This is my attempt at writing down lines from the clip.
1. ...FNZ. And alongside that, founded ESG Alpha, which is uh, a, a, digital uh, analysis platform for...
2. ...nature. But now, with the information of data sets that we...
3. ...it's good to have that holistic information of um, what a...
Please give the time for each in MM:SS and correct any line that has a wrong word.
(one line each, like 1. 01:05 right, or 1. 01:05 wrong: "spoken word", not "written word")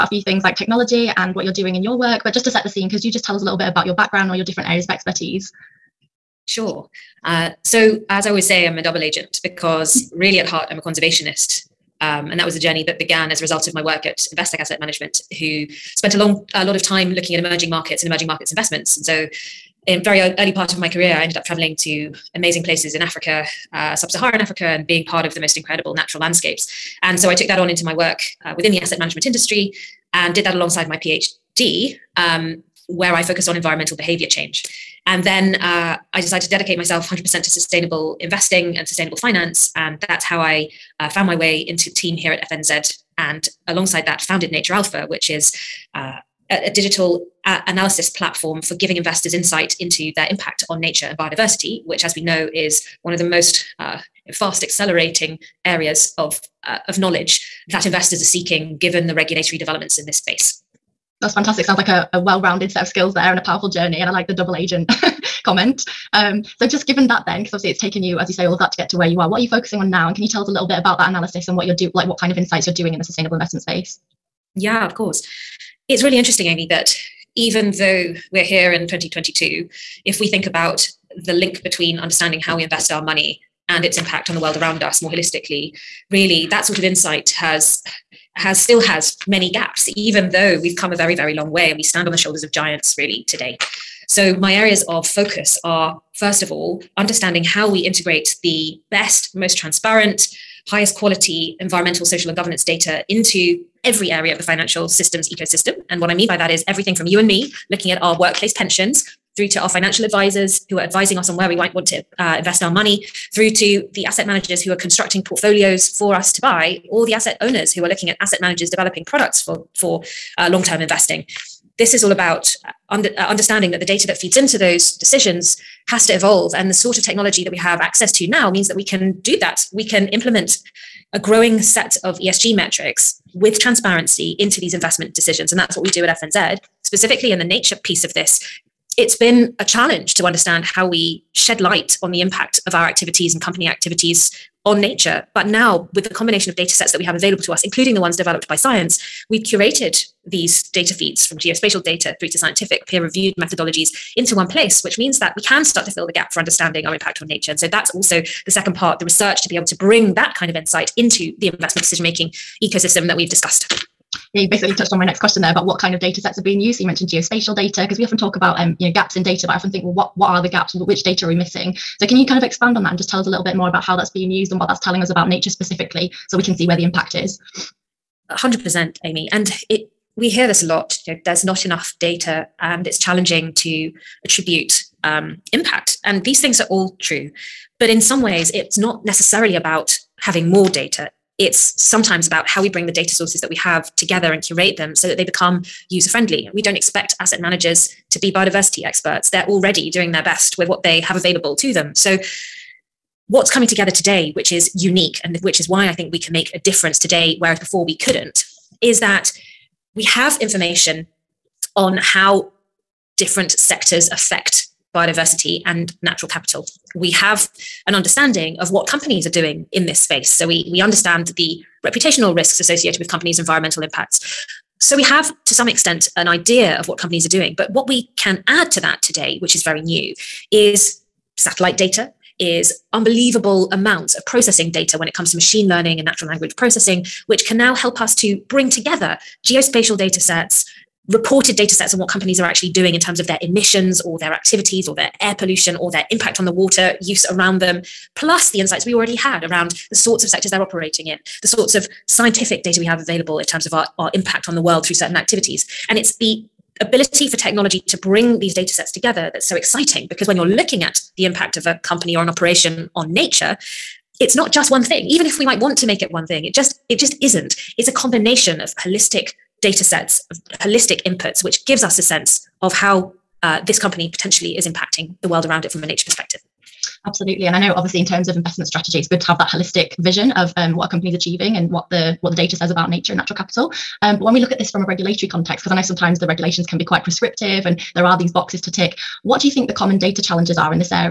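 1. 00:42 wrong: "Nature", not "ESG"
2. 02:24 wrong: "combination", not "information"
3. 04:38 wrong: "vision", not "information".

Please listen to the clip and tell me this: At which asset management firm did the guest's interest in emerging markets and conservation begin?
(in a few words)
Investec Asset Management.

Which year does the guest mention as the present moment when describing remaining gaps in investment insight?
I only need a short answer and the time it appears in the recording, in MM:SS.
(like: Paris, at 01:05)
2022, at 01:18.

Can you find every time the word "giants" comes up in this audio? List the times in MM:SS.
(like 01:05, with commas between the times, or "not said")
01:32.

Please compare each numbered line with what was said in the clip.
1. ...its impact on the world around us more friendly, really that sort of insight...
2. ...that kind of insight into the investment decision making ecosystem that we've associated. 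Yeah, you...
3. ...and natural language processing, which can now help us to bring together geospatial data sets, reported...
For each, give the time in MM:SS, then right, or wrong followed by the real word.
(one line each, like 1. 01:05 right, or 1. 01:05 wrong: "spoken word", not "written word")
1. 01:23 wrong: "holistically", not "friendly"
2. 02:40 wrong: "discussed", not "associated"
3. 03:56 right.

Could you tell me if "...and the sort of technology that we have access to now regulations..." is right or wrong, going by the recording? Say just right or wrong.
wrong.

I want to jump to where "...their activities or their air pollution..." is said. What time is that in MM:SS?
04:04.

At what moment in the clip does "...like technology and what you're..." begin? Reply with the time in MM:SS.
00:00.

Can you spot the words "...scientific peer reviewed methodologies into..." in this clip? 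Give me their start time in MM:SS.
02:32.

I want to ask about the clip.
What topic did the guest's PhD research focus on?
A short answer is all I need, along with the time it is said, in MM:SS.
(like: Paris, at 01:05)
environmental behavior change, at 00:33.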